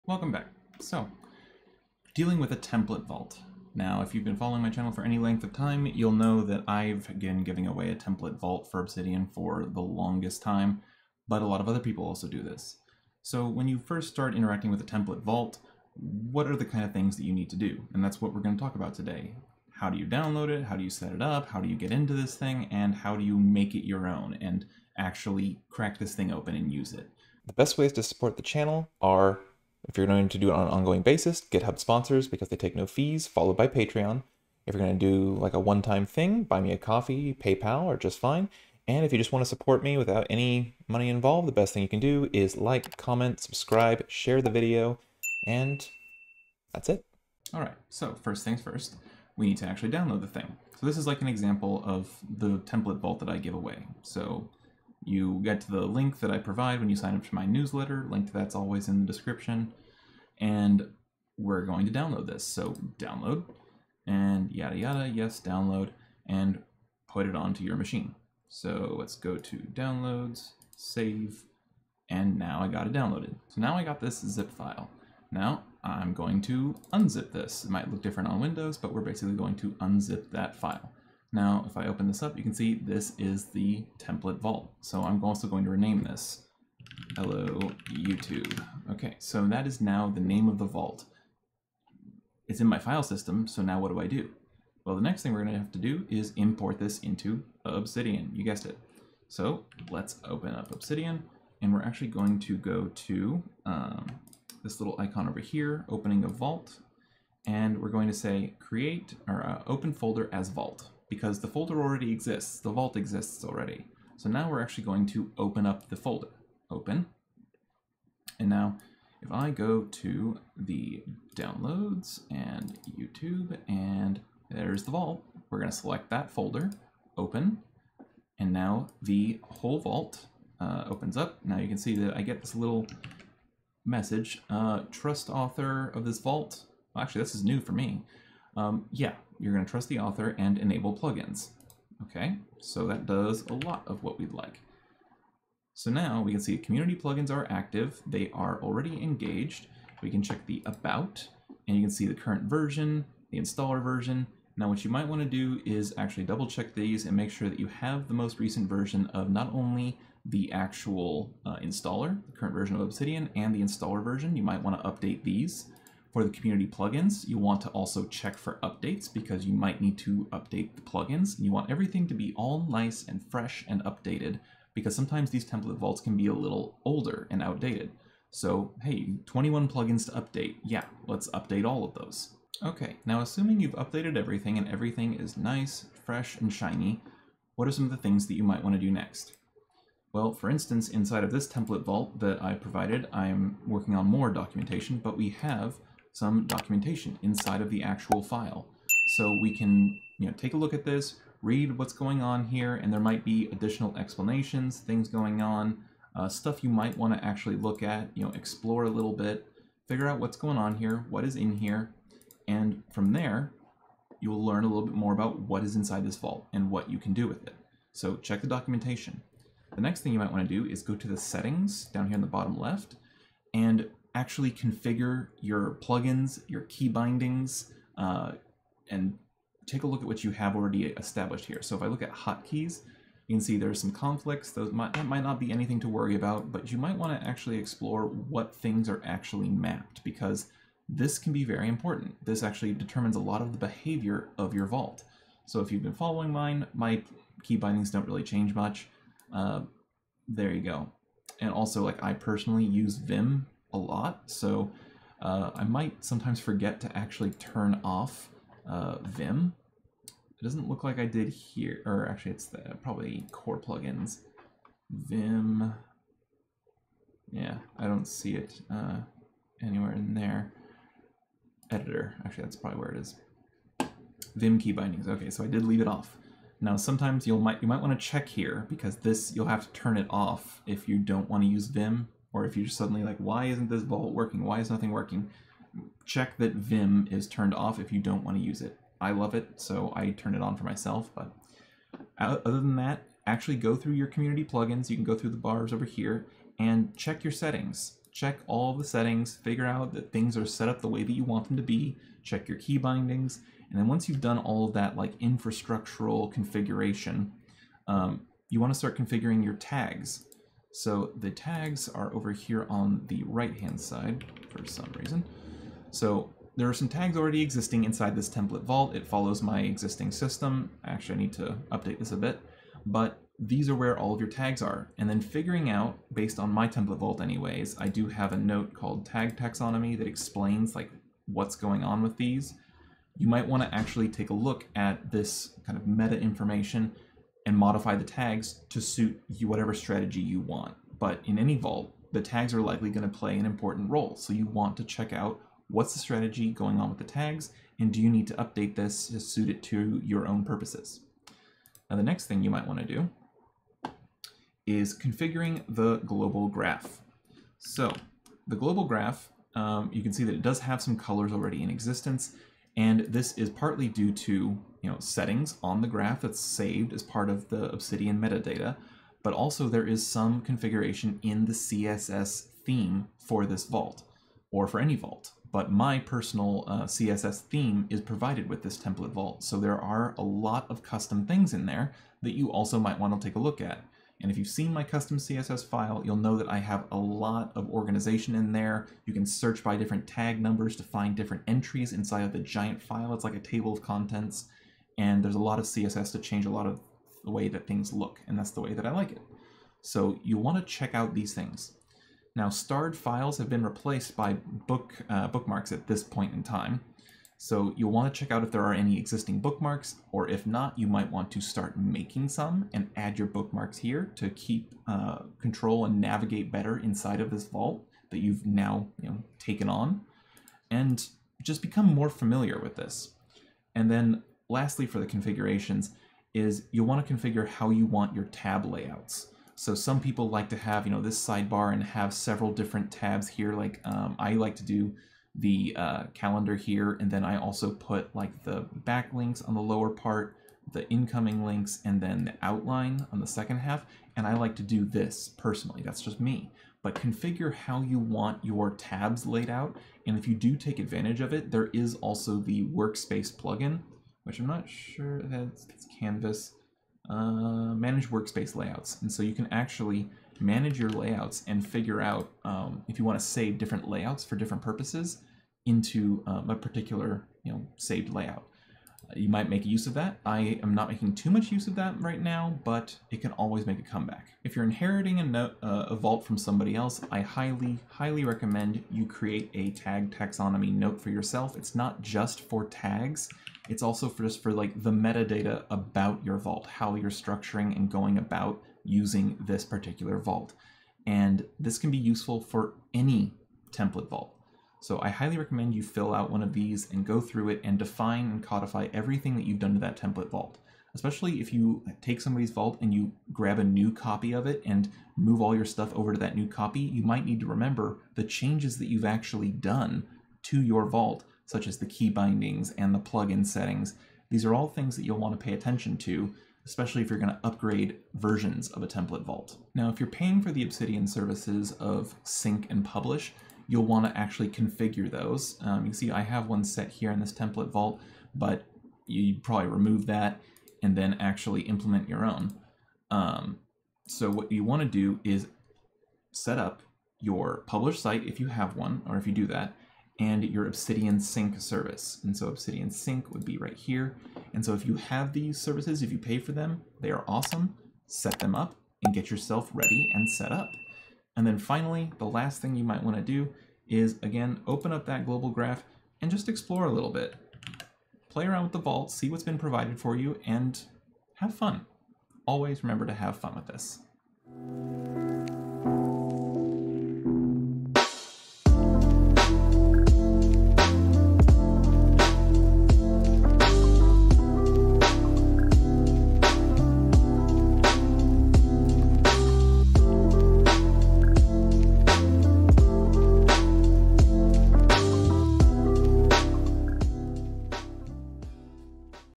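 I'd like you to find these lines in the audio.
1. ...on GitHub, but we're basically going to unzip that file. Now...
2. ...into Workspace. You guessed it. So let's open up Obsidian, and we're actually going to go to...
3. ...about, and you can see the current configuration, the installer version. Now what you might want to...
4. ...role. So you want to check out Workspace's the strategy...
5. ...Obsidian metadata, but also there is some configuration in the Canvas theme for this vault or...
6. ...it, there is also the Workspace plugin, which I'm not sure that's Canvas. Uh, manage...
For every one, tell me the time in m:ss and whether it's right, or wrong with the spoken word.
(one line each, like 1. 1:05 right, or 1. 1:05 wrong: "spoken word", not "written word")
1. 1:18 wrong: "Windows", not "GitHub"
2. 1:36 wrong: "Obsidian", not "Workspace"
3. 2:30 wrong: "version", not "configuration"
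4. 5:43 wrong: "What", not "Workspace"
5. 6:07 wrong: "CSS", not "Canvas"
6. 7:31 right.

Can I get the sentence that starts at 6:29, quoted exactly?
You can search by different tag numbers to find different entries inside of the giant file.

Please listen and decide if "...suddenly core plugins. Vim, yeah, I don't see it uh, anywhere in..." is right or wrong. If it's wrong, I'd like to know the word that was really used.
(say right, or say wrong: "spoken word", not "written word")
wrong: "probably", not "suddenly".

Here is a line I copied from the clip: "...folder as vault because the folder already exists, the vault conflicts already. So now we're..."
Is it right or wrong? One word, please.
wrong.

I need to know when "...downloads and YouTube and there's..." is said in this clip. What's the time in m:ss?
2:01.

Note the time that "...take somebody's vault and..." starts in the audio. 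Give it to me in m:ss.
8:22.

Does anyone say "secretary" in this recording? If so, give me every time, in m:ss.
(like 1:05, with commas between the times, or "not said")
not said.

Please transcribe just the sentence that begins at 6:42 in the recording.
Now starred files have been replaced by book uh, bookmarks at this point in time.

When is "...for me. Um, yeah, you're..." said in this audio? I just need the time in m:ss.
2:17.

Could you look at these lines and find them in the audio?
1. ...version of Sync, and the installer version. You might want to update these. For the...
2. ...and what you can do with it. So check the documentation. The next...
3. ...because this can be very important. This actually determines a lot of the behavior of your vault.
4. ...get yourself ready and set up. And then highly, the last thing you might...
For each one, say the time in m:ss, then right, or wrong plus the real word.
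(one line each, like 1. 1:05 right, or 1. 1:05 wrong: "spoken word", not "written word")
1. 2:42 wrong: "Obsidian", not "Sync"
2. 3:36 right
3. 4:00 right
4. 9:09 wrong: "finally", not "highly".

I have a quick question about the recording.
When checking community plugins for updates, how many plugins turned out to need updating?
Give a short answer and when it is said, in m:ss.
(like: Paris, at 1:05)
21, at 2:59.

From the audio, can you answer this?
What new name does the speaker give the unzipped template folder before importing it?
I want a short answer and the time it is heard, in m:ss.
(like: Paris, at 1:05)
Hello, YouTube, at 1:27.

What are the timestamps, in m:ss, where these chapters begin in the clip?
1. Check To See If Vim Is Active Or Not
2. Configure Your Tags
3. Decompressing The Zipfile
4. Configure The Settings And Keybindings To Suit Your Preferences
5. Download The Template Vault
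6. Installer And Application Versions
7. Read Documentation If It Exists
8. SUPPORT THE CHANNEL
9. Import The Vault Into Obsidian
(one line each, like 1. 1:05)
1. 4:11
2. 5:08
3. 1:13
4. 3:39
5. 0:47
6. 2:31
7. 3:02
8. 0:27
9. 1:41.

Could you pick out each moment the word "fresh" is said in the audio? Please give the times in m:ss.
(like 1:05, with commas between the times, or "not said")
2:53, 3:06.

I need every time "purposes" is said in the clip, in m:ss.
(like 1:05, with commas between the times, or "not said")
5:50, 7:44.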